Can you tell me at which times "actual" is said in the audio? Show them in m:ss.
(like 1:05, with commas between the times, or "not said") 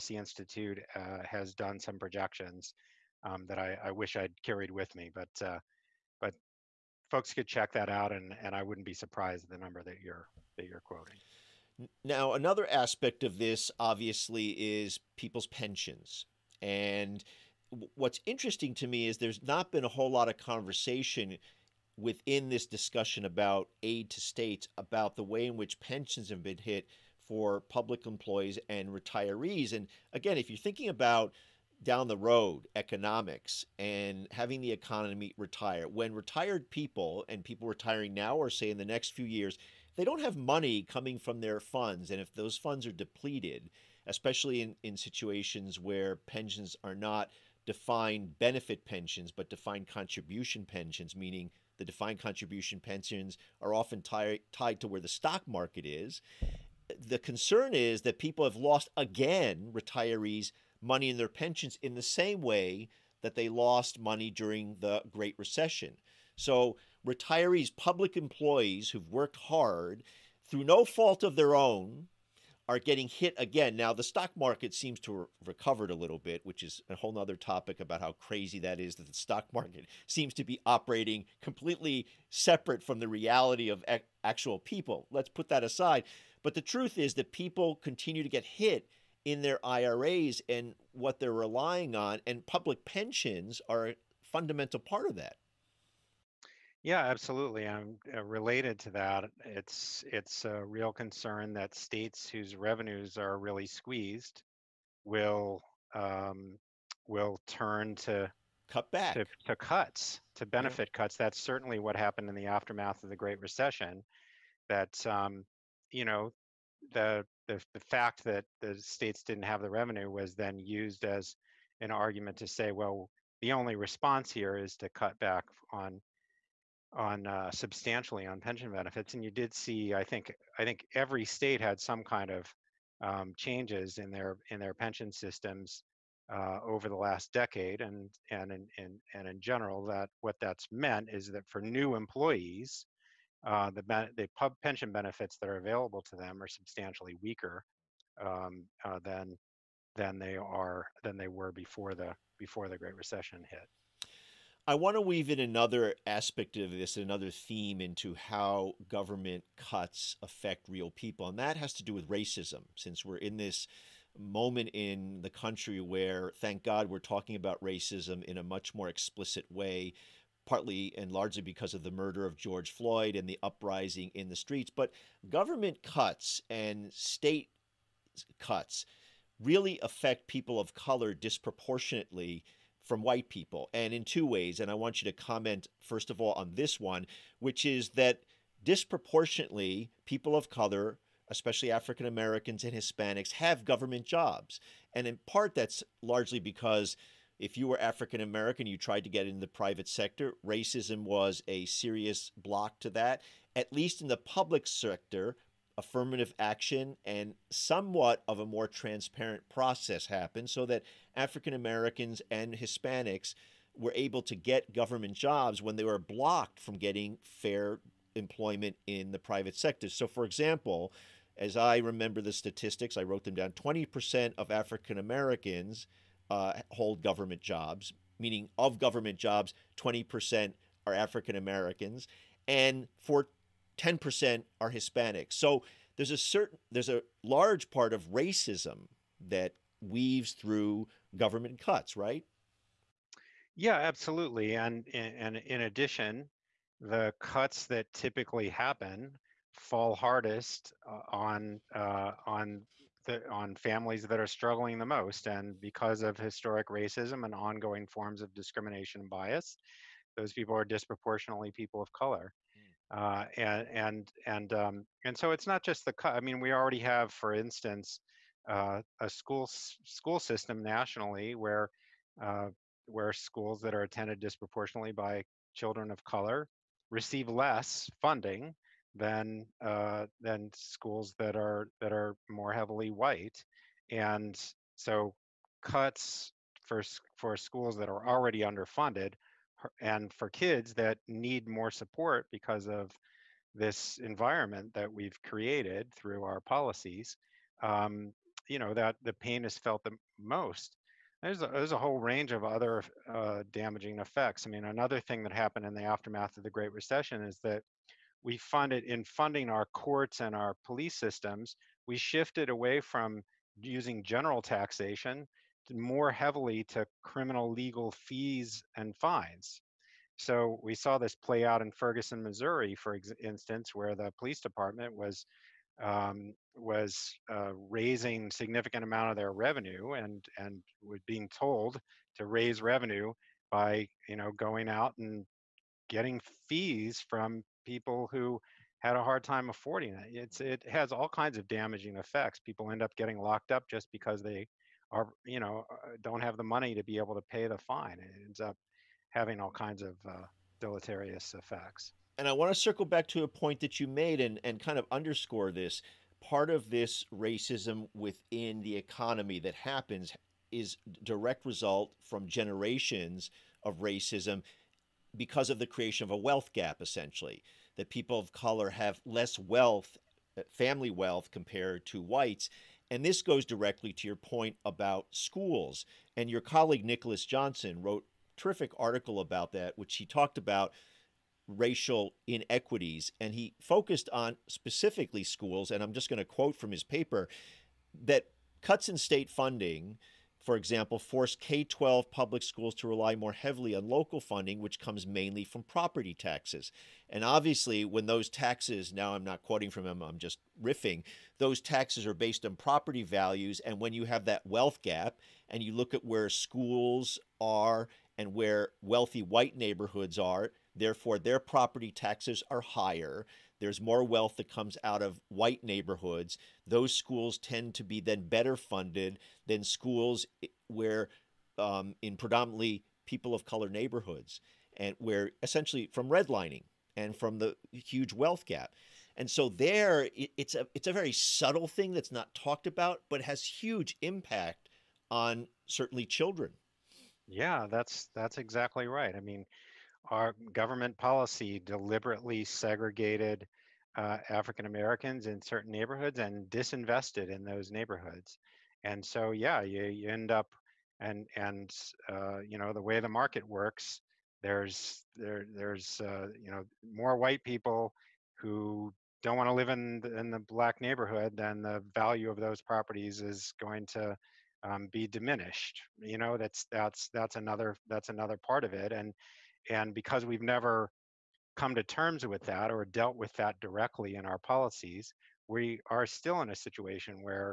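1:24.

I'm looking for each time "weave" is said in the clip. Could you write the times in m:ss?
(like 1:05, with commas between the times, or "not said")
2:35, 3:59.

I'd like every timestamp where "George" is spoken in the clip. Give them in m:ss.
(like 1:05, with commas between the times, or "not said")
2:52.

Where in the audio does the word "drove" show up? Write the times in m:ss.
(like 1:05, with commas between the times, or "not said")
not said.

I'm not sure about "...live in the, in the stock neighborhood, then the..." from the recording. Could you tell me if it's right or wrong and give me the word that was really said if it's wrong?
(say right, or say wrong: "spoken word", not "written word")
wrong: "black", not "stock".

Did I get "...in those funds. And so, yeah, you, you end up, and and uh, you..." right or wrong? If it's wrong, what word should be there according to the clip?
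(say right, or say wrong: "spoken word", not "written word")
wrong: "neighborhoods", not "funds".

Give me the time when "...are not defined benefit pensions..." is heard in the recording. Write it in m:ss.
0:46.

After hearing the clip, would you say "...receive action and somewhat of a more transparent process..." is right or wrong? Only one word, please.
wrong.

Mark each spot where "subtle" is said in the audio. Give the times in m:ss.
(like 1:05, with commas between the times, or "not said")
7:11.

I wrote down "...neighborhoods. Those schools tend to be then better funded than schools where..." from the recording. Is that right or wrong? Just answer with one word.
right.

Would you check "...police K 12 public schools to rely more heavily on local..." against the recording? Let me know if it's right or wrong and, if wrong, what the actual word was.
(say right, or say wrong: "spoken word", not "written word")
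wrong: "force", not "police".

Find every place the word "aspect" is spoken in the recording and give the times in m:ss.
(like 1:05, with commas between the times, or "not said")
0:12, 2:36.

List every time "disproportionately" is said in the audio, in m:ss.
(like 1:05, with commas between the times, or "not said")
3:01, 3:08, 4:20, 4:34.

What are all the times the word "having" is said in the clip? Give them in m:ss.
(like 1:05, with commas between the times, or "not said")
0:34, 5:49.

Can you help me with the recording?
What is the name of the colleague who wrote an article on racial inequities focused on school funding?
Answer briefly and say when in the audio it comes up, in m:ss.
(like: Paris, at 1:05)
Nicholas Johnson, at 6:16.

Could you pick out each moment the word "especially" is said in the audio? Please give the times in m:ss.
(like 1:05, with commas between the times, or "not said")
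0:44, 3:11.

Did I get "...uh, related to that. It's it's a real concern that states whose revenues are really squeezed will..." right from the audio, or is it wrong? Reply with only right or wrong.
right.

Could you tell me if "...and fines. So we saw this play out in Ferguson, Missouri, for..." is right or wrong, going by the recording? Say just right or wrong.
right.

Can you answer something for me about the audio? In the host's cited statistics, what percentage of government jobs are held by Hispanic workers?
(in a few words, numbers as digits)
10%.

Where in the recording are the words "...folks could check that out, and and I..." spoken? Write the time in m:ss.
0:07.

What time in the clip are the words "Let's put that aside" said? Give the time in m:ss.
1:25.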